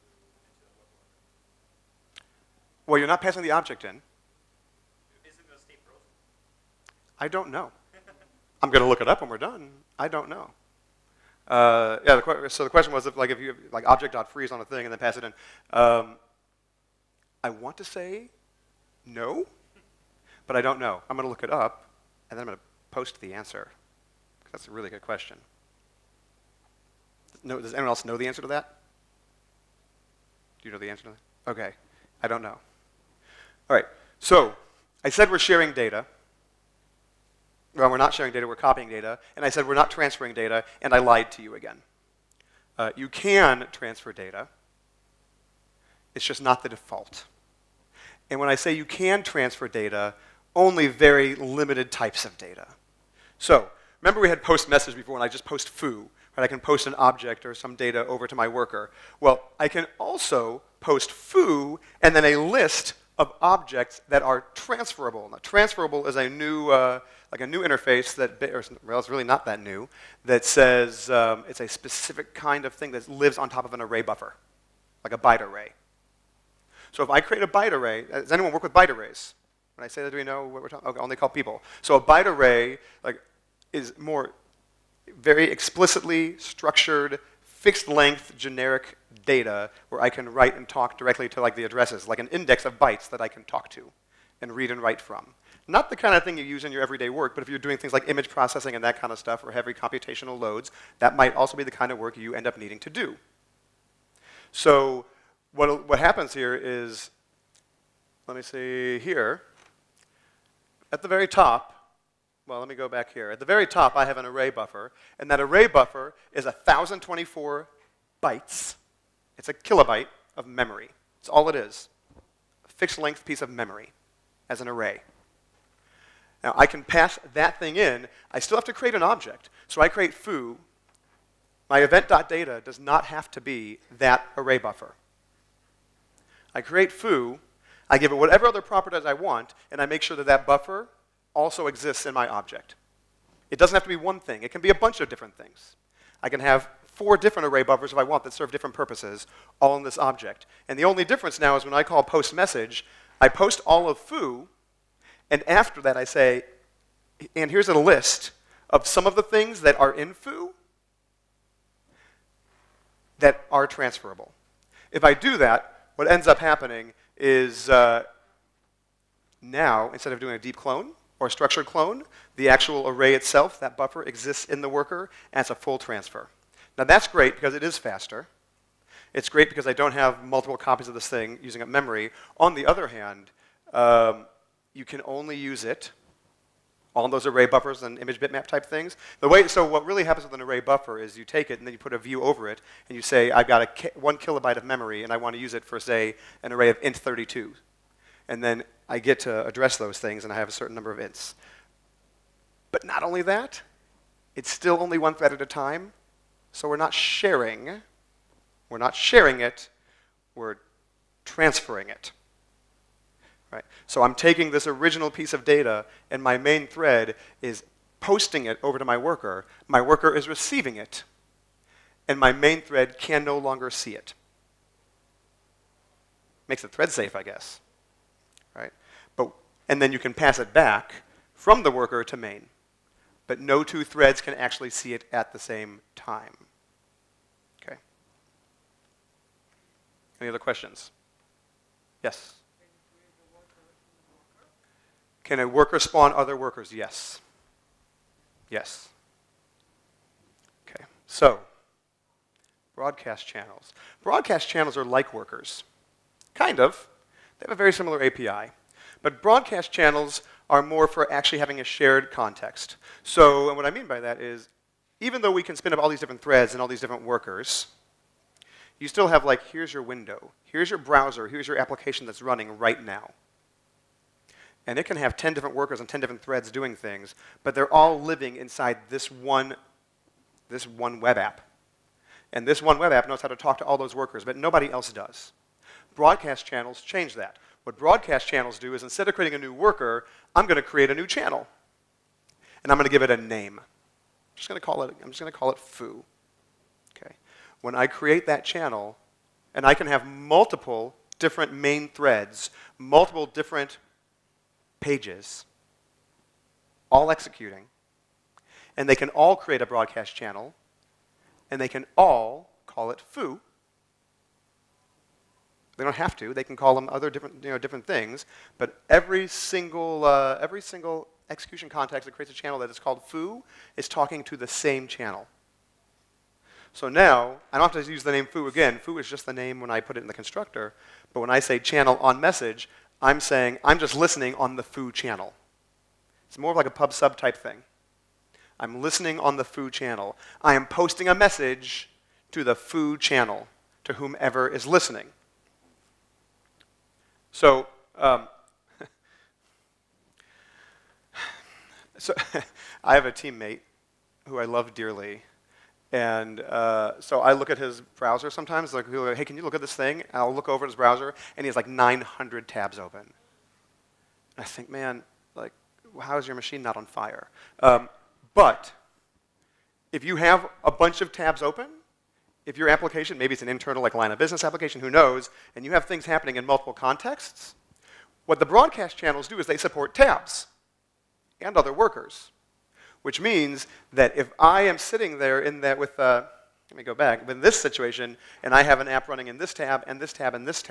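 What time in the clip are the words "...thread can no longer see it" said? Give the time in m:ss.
3:42.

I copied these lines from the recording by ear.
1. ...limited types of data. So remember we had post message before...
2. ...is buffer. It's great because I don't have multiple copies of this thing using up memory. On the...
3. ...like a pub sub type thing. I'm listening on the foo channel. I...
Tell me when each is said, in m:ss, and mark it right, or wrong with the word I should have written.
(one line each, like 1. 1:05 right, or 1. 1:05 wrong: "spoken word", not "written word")
1. 0:51 right
2. 2:57 wrong: "faster", not "buffer"
3. 5:36 right.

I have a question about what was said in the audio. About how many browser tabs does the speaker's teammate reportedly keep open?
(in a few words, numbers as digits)
900.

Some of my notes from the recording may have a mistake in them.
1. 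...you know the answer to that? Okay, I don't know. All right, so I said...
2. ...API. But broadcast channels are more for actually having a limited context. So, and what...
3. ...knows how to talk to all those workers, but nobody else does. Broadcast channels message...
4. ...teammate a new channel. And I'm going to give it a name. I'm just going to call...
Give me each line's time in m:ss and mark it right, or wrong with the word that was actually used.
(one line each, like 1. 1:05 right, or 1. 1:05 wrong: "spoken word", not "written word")
1. 0:30 right
2. 4:18 wrong: "shared", not "limited"
3. 4:43 wrong: "change", not "message"
4. 4:50 wrong: "create", not "teammate".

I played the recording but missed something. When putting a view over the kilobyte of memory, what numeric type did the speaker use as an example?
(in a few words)
int32.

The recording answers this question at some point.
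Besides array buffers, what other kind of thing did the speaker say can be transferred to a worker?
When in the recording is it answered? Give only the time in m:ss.
3:07.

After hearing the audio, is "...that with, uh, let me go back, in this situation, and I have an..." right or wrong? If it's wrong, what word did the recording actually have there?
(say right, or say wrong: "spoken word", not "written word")
right.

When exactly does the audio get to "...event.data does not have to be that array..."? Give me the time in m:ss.
2:11.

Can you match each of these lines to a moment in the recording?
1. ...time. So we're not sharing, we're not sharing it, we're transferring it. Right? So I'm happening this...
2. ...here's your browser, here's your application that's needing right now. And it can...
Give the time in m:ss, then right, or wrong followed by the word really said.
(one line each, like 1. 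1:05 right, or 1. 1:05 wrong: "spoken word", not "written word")
1. 3:25 wrong: "taking", not "happening"
2. 4:30 wrong: "running", not "needing".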